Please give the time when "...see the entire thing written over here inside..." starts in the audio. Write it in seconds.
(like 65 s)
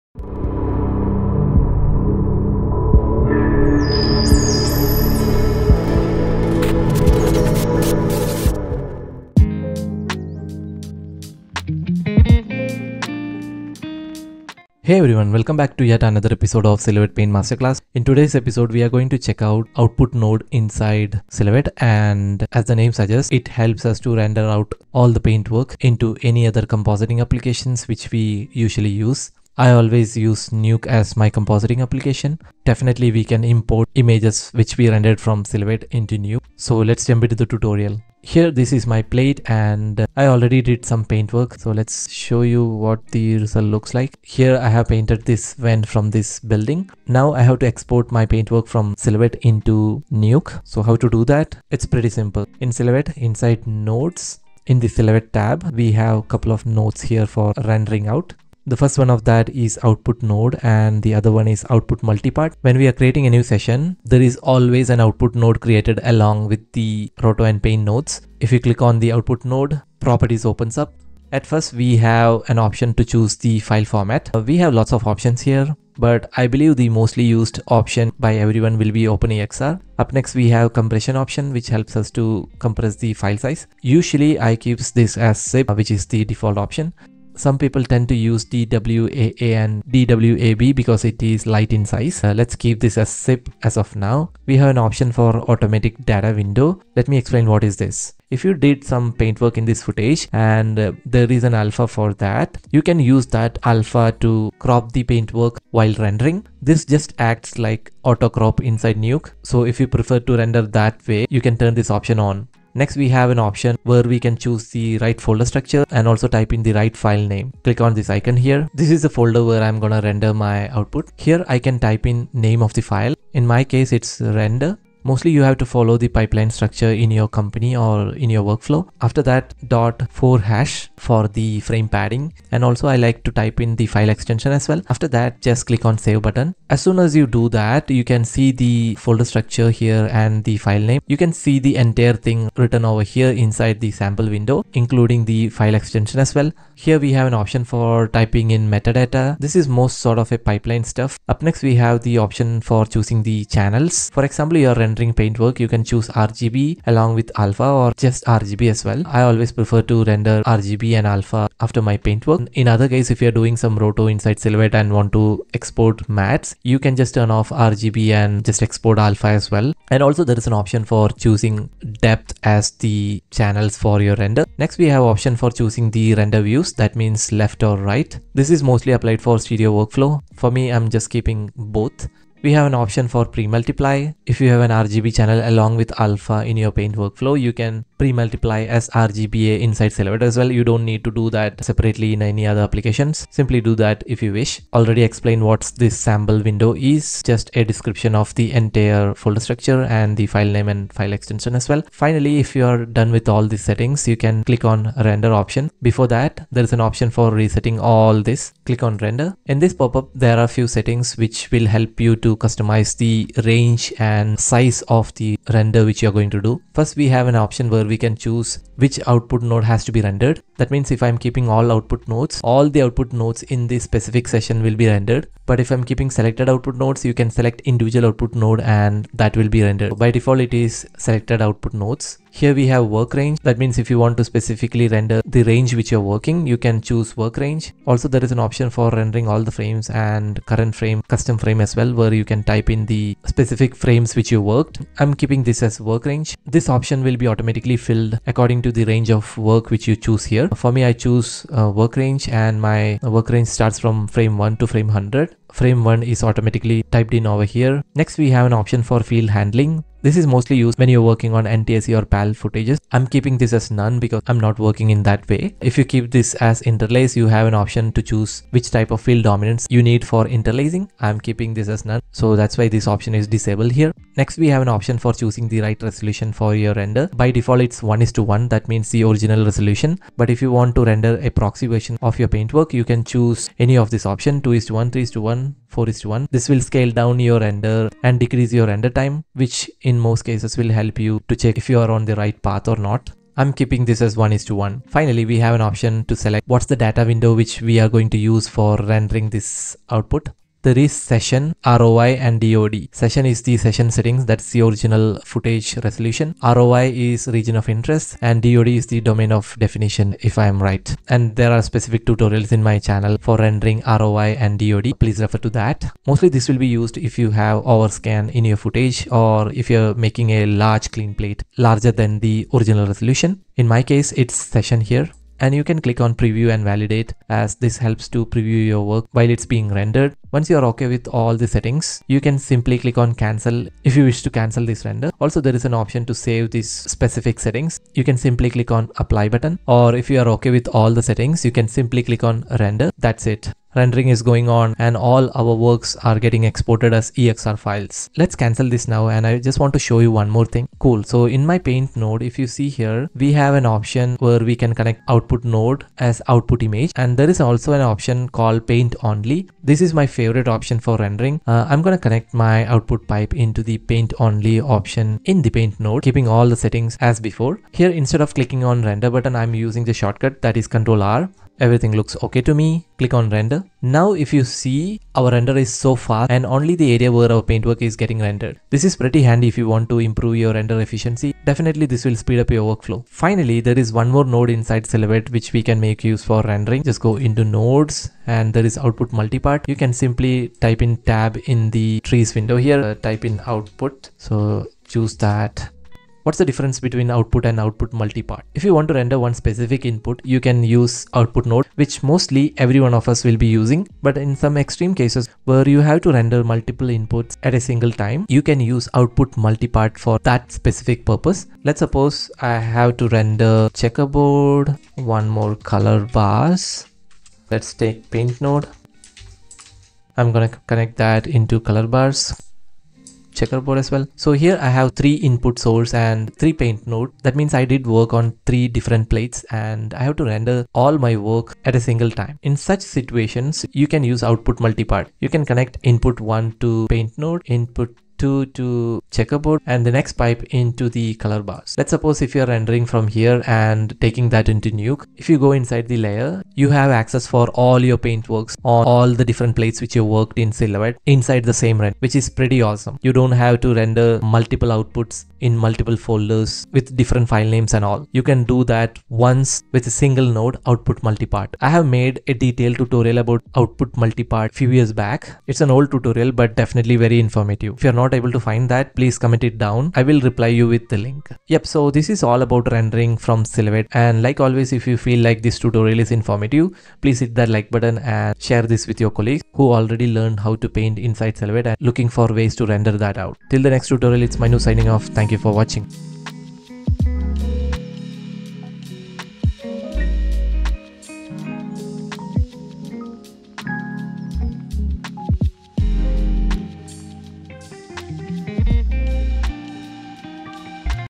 141 s.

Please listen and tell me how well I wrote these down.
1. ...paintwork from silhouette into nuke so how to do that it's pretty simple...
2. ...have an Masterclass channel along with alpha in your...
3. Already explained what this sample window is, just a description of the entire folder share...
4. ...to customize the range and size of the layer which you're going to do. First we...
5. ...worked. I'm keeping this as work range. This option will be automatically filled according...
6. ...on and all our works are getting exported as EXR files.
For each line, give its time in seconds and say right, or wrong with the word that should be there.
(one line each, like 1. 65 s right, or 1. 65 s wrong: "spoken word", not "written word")
1. 48 s right
2. 184 s wrong: "RGB", not "Masterclass"
3. 194 s wrong: "structure", not "share"
4. 212 s wrong: "render", not "layer"
5. 244 s right
6. 344 s right.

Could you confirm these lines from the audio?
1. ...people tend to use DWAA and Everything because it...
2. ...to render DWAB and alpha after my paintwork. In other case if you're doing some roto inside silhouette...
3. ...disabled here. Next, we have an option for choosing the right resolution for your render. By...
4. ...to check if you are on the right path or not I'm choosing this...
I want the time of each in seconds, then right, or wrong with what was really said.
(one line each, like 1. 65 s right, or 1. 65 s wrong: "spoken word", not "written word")
1. 87 s wrong: "DWAB", not "Everything"
2. 159 s wrong: "RGB", not "DWAB"
3. 273 s right
4. 291 s wrong: "keeping", not "choosing".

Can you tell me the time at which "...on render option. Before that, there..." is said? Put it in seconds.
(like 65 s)
204 s.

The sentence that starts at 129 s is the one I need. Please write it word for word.
After that dot 4 hash for the frame padding and also I like to type in the file extension as well.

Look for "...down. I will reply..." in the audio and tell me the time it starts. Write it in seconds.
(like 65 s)
469 s.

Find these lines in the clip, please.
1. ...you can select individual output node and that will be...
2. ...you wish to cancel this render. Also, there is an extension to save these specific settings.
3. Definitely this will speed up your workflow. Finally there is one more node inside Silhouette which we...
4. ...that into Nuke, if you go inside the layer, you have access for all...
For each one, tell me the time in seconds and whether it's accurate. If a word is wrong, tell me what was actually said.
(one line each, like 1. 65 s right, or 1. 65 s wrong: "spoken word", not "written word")
1. 227 s right
2. 333 s wrong: "option", not "extension"
3. 381 s right
4. 444 s right.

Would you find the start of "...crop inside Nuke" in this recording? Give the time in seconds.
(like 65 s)
108 s.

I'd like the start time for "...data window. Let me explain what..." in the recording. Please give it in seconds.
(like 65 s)
96 s.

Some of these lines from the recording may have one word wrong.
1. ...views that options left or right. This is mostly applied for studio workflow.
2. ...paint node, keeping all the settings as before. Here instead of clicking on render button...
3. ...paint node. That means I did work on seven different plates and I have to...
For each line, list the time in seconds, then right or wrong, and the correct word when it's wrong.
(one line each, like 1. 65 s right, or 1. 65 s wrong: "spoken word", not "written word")
1. 176 s wrong: "means", not "options"
2. 365 s right
3. 426 s wrong: "three", not "seven".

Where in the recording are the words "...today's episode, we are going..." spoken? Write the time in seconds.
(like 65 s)
18 s.